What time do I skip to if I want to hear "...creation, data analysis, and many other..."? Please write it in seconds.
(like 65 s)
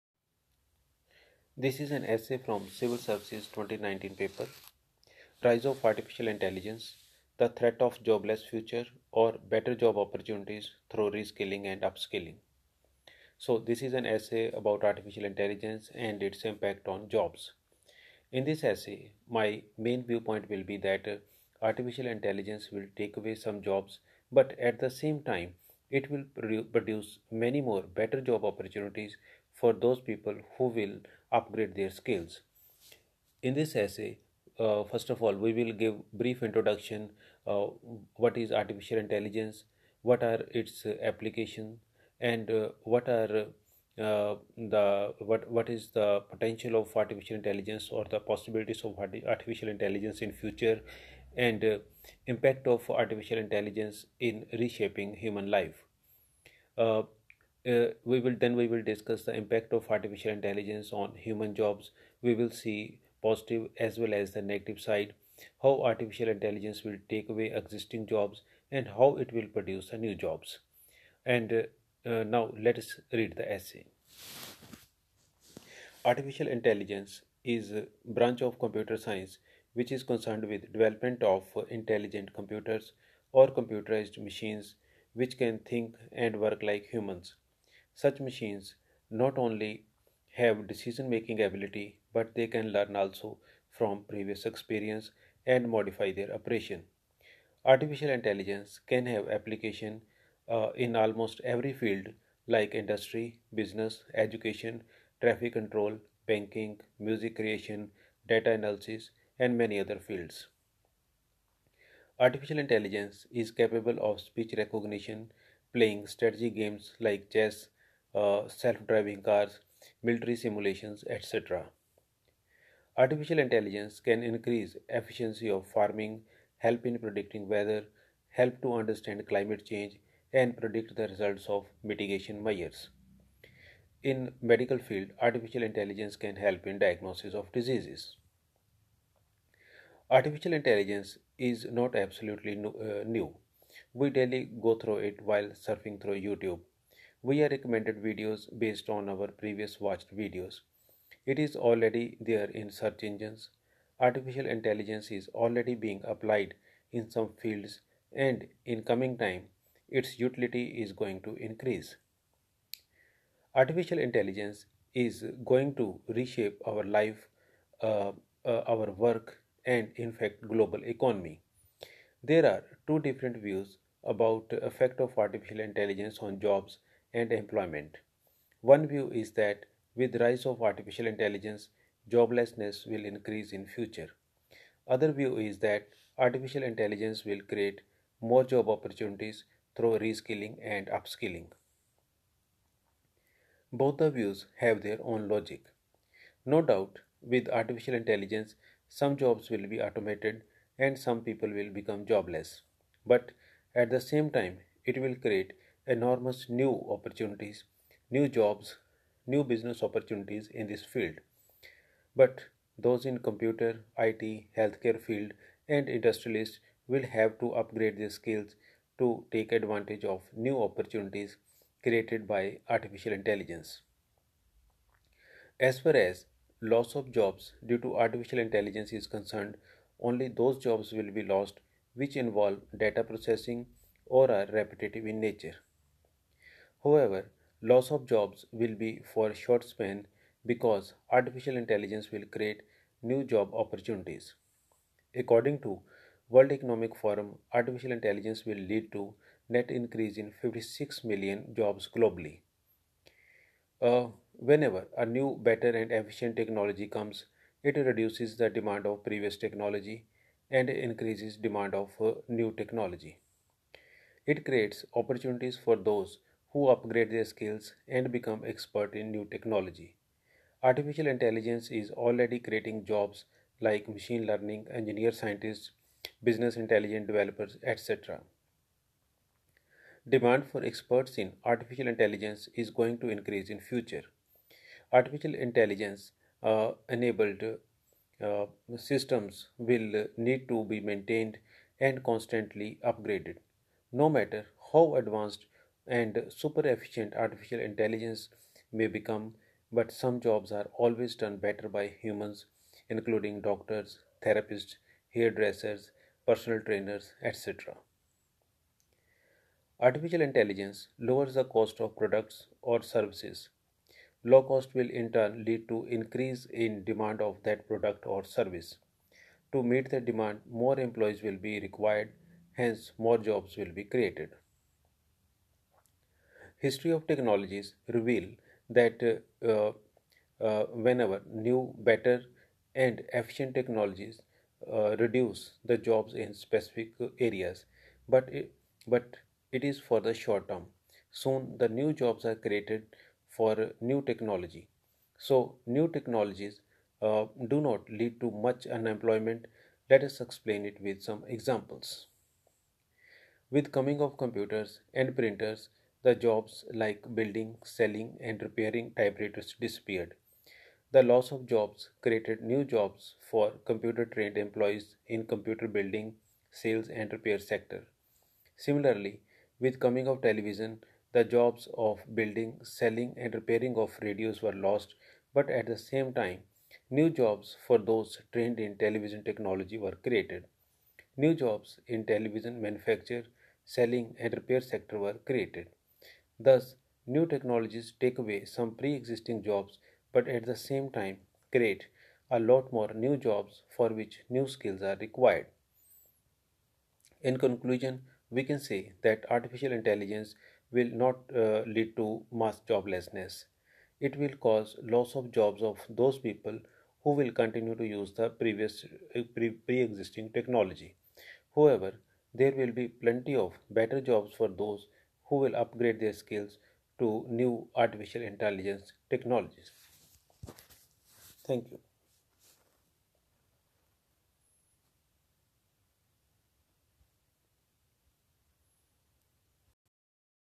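107 s.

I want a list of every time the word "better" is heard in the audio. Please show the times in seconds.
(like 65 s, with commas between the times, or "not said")
9 s, 27 s, 255 s, 301 s, 331 s, 413 s.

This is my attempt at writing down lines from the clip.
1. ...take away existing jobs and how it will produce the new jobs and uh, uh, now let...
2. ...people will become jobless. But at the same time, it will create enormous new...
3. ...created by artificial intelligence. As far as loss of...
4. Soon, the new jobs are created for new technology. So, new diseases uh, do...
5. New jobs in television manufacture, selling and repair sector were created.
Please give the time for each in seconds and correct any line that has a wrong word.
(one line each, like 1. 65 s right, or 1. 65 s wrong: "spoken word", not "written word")
1. 67 s right
2. 201 s right
3. 221 s right
4. 341 s wrong: "technologies", not "diseases"
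5. 381 s right.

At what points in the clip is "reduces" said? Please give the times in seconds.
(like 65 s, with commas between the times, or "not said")
257 s, 334 s.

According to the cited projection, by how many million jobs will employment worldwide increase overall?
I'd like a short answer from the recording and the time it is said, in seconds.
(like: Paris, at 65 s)
56 million, at 250 s.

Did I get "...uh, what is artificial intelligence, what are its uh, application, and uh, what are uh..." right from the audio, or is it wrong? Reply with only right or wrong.
right.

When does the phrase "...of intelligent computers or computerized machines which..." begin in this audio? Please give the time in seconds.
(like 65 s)
81 s.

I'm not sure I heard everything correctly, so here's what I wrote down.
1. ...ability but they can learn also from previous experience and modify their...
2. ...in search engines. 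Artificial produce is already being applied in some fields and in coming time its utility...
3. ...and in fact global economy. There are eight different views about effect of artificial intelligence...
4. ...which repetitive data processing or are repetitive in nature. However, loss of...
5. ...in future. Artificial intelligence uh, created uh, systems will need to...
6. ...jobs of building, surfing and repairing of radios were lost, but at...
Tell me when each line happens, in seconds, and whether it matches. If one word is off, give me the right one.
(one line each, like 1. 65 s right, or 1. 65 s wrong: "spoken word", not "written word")
1. 91 s right
2. 152 s wrong: "intelligence", not "produce"
3. 169 s wrong: "two", not "eight"
4. 231 s wrong: "involve", not "repetitive"
5. 283 s wrong: "enabled", not "created"
6. 371 s wrong: "selling", not "surfing".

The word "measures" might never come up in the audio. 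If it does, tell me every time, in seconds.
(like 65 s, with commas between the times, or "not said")
132 s.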